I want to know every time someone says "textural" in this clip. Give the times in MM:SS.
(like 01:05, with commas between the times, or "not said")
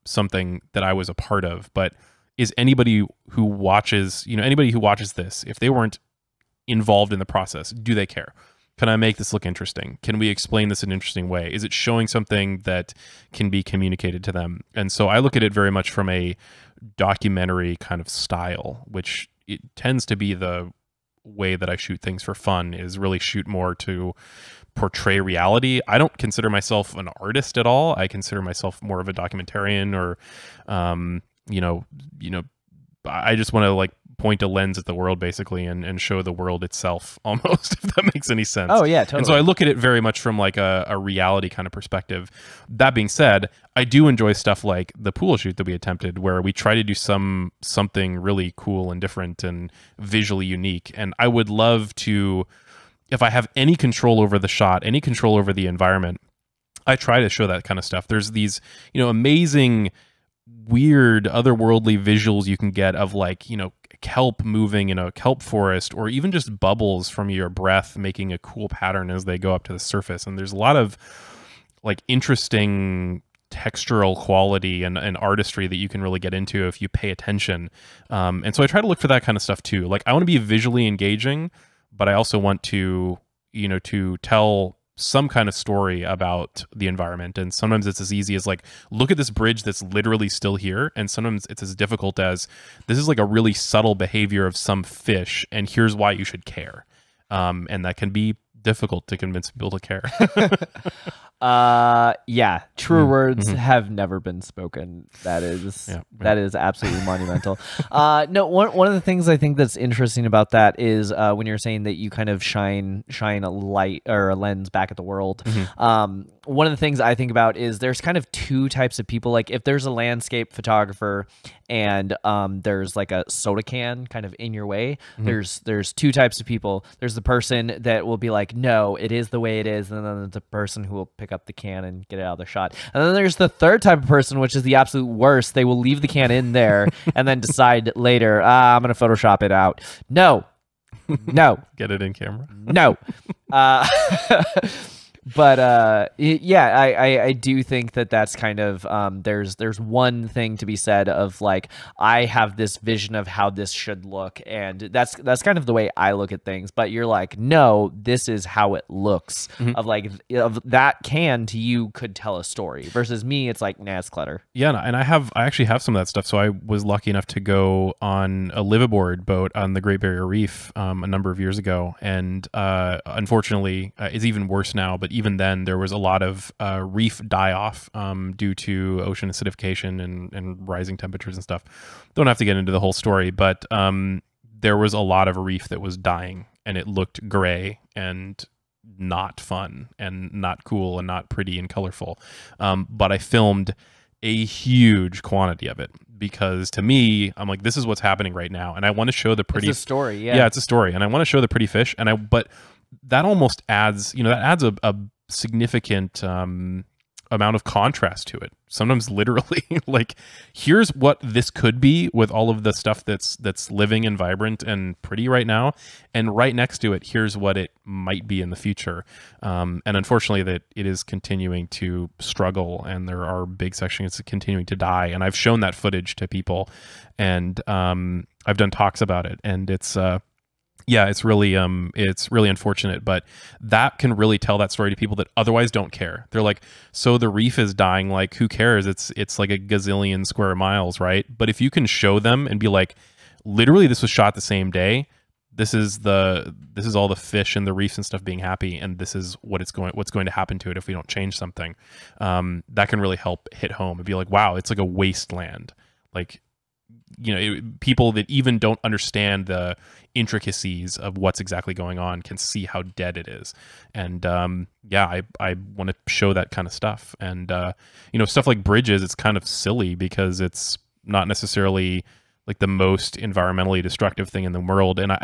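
01:13.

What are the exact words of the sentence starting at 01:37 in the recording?
Um, and that can be difficult to convince people to care.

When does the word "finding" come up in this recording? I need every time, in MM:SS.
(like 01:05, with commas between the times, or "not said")
not said.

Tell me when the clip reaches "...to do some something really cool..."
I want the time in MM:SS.
00:46.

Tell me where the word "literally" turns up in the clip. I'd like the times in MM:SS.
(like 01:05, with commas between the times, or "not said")
01:29, 03:29, 04:03.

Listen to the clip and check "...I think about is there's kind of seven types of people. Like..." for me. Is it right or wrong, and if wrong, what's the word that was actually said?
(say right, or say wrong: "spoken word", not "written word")
wrong: "two", not "seven".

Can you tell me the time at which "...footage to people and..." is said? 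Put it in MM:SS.
03:45.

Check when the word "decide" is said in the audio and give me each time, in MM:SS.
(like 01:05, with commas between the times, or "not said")
02:17.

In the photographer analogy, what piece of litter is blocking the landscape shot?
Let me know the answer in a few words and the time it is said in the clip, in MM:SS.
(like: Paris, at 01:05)
soda can, at 02:03.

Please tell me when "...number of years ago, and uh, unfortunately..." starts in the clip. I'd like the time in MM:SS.
02:51.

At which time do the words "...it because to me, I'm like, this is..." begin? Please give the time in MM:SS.
03:15.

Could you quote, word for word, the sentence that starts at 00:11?
Is it showing something that can be communicated to them?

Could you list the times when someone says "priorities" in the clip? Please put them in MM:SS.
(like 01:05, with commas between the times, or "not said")
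not said.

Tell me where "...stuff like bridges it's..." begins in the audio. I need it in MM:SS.
04:28.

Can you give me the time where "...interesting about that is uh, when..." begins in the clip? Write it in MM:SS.
01:49.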